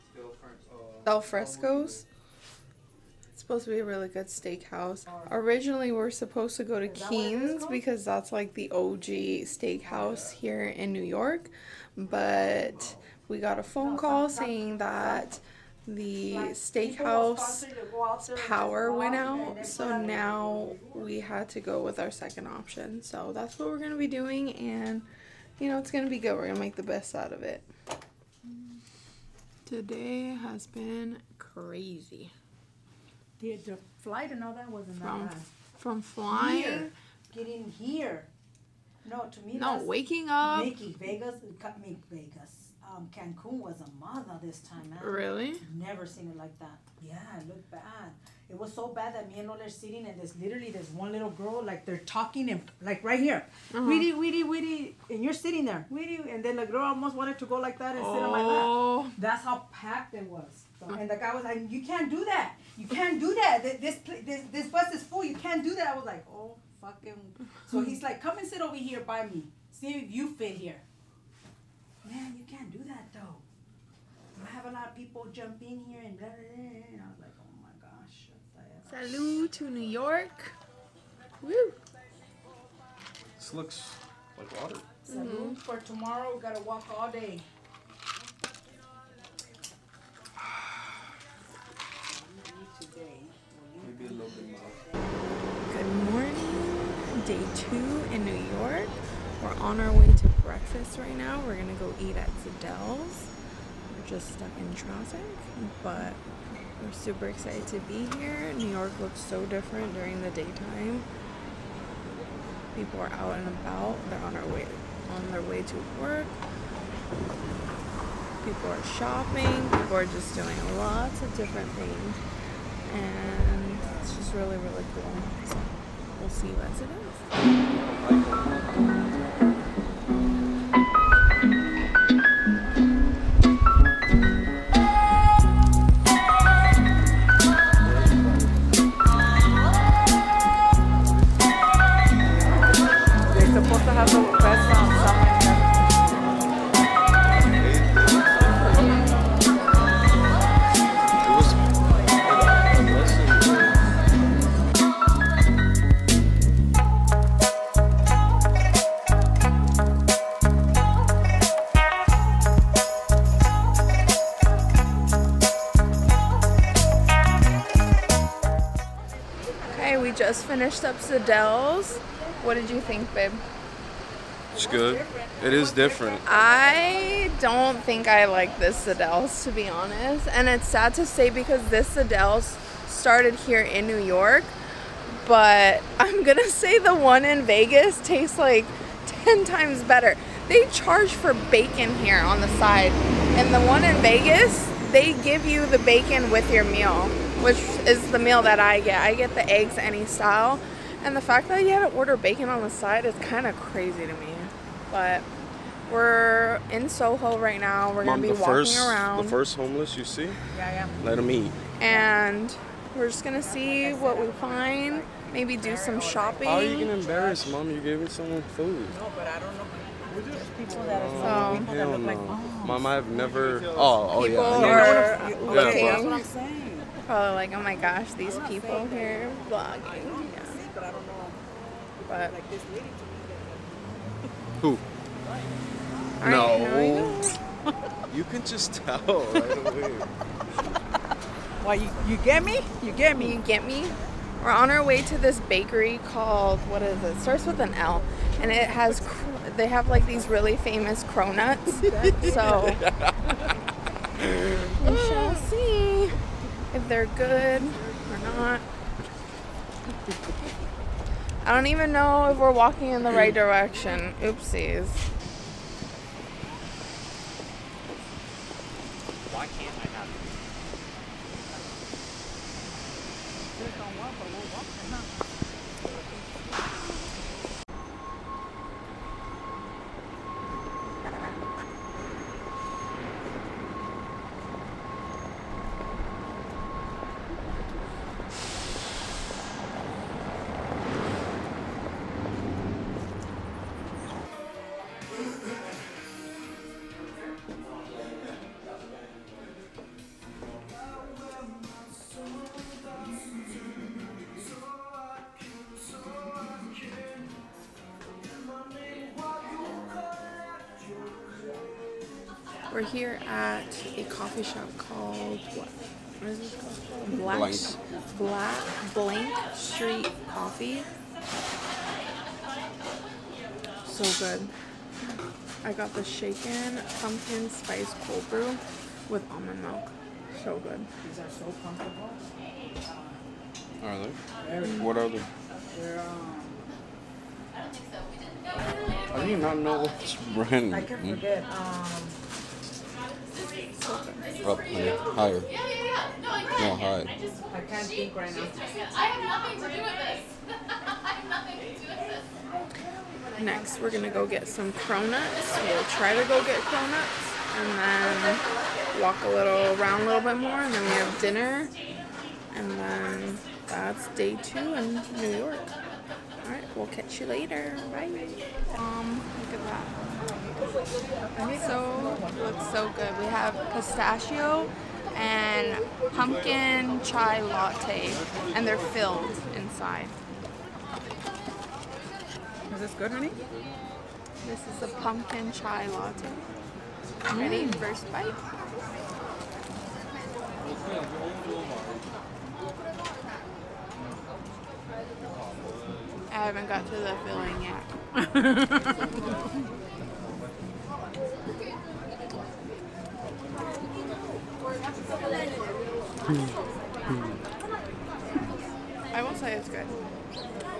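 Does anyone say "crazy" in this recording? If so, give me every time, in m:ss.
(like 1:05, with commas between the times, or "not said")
0:31, 3:23.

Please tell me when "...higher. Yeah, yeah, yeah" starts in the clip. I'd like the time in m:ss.
5:44.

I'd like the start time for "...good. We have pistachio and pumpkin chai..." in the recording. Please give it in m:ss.
6:12.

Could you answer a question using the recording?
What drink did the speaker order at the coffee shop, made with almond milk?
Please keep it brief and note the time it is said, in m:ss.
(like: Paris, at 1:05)
shaken pumpkin spice cold brew, at 5:26.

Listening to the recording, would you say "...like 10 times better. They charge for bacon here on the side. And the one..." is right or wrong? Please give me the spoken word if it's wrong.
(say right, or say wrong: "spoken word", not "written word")
right.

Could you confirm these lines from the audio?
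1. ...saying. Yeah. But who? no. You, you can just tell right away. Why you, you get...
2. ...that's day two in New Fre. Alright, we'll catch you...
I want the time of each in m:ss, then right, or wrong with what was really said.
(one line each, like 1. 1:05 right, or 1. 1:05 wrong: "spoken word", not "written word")
1. 3:49 wrong: "vlogging", not "saying"
2. 6:03 wrong: "York", not "Fre".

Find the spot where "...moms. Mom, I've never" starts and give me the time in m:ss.
3:42.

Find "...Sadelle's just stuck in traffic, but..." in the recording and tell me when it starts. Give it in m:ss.
1:42.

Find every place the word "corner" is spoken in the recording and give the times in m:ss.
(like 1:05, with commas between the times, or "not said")
not said.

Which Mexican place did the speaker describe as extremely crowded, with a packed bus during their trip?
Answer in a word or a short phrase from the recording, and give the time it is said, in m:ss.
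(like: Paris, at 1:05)
Cancun, at 0:43.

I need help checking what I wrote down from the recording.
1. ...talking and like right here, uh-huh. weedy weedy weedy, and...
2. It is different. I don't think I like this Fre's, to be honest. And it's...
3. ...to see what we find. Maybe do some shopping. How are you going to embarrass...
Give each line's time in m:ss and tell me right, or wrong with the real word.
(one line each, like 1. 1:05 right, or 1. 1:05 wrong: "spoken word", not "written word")
1. 0:51 right
2. 2:55 wrong: "Sadelle", not "Fre"
3. 3:33 right.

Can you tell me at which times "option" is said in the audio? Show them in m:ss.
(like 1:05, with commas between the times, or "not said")
0:22.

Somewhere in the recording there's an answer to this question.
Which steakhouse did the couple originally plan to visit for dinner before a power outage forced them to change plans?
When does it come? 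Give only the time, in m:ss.
0:06.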